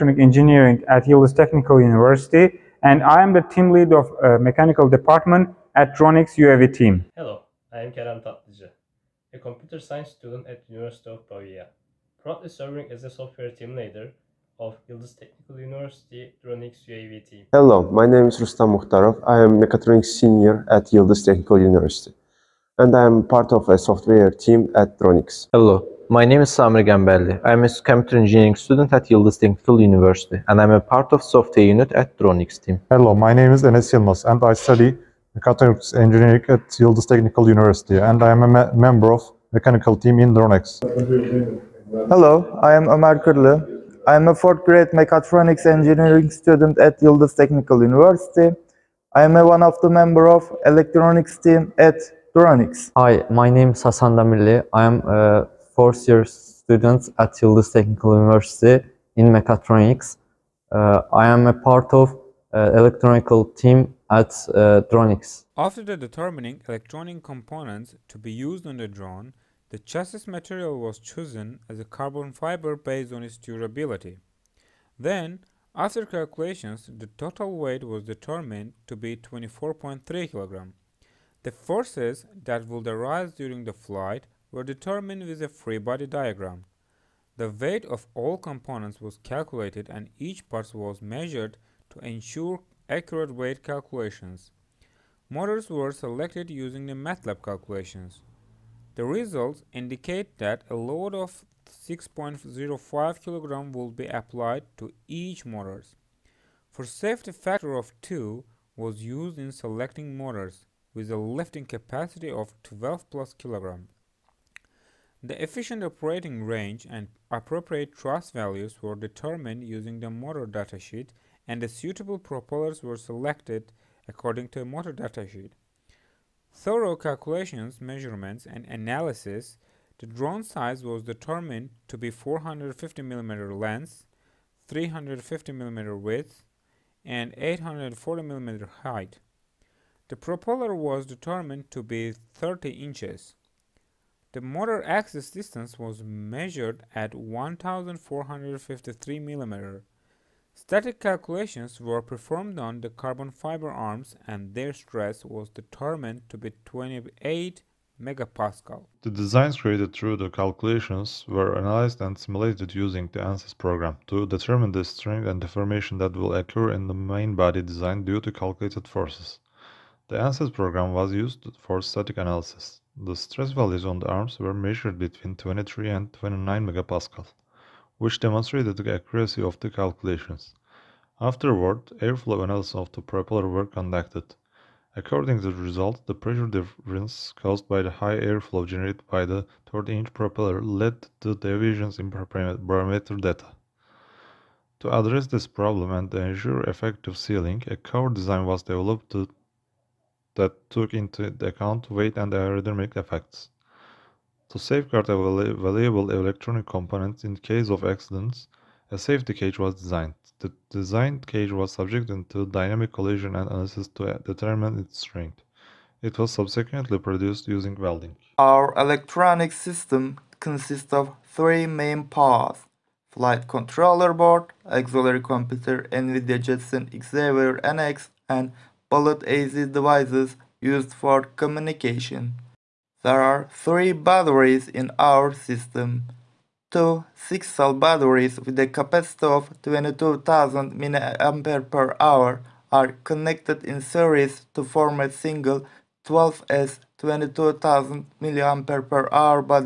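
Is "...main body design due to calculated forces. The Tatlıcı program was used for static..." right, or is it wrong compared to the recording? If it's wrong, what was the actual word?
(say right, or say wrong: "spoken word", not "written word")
wrong: "ANSYS", not "Tatlıcı".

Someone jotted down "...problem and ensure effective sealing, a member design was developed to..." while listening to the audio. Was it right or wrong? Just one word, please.
wrong.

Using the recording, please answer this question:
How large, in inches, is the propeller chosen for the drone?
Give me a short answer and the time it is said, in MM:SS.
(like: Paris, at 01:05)
30 inches, at 02:22.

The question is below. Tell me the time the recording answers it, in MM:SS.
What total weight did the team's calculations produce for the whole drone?
01:19.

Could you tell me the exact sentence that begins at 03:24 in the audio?
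To safeguard a valuable electronic component in case of accidents, a safety cage was designed.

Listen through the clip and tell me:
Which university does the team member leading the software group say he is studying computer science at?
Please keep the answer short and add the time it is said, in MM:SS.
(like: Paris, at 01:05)
University of Pavia, at 00:10.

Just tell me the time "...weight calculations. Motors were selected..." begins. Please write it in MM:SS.
01:33.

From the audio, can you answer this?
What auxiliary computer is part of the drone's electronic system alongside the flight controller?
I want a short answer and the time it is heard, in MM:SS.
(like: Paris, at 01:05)
NVIDIA Jetson Xavier NX, at 03:45.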